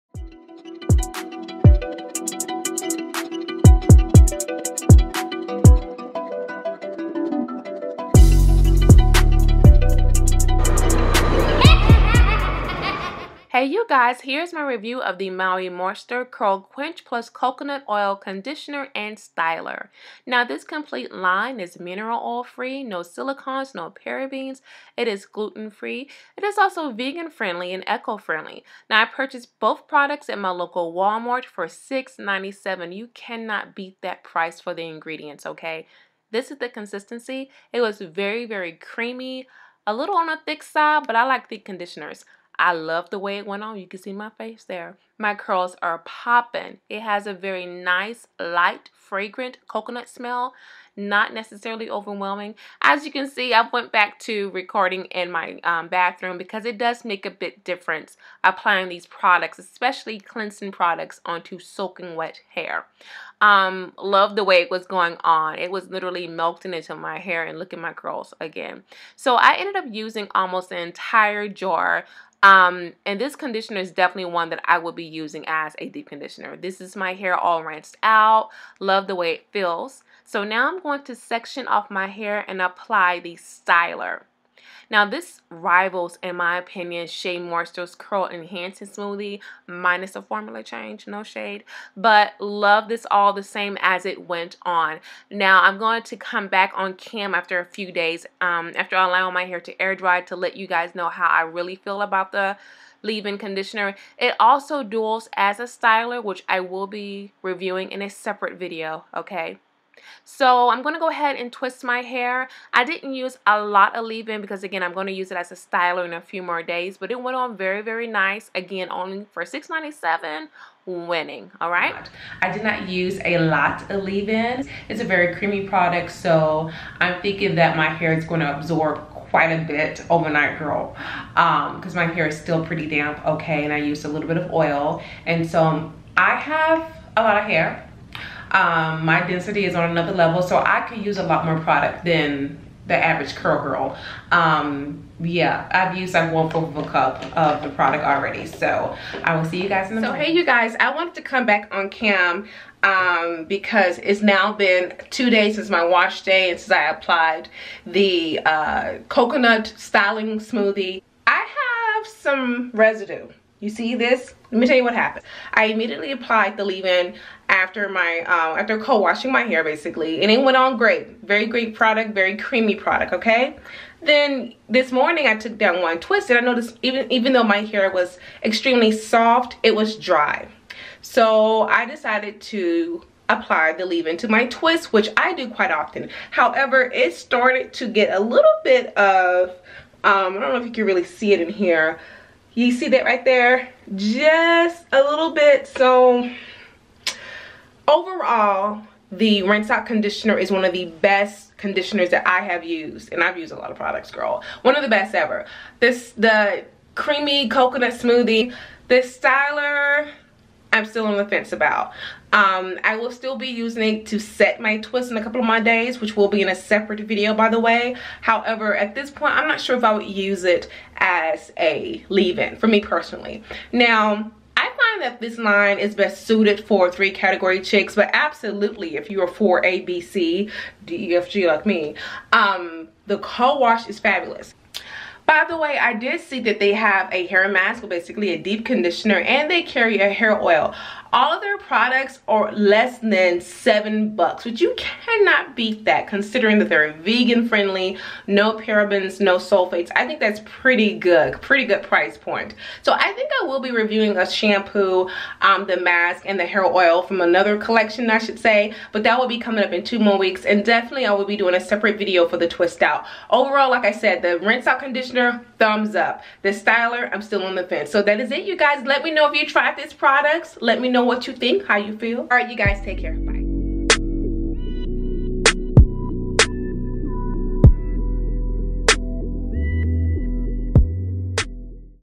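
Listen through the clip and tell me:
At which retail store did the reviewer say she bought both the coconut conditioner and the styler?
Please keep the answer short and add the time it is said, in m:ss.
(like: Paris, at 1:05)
Walmart, at 0:30.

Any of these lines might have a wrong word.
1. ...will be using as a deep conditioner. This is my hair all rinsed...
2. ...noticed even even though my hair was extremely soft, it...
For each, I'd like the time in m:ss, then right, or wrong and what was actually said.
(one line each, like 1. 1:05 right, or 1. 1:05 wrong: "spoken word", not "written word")
1. 1:14 right
2. 2:56 right.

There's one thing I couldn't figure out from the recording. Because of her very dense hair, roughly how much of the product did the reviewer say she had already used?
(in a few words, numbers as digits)
1/4 of a cup.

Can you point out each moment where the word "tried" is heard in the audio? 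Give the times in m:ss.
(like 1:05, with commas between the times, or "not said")
4:29.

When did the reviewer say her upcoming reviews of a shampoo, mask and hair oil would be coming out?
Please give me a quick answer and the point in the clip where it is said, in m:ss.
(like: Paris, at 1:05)
In 2 more weeks, at 4:19.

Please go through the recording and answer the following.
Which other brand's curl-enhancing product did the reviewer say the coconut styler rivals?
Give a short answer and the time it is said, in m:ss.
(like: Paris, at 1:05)
Shea Moisture, at 1:27.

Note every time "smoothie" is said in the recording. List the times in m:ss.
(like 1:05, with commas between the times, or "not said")
1:28, 2:40, 3:27.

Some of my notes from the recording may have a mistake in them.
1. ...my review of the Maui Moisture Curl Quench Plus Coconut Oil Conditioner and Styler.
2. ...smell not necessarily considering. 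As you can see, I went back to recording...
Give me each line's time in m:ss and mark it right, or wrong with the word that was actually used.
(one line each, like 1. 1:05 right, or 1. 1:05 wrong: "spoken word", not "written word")
1. 0:14 right
2. 0:50 wrong: "overwhelming", not "considering".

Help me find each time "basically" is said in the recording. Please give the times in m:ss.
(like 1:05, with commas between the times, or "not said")
2:49, 3:57.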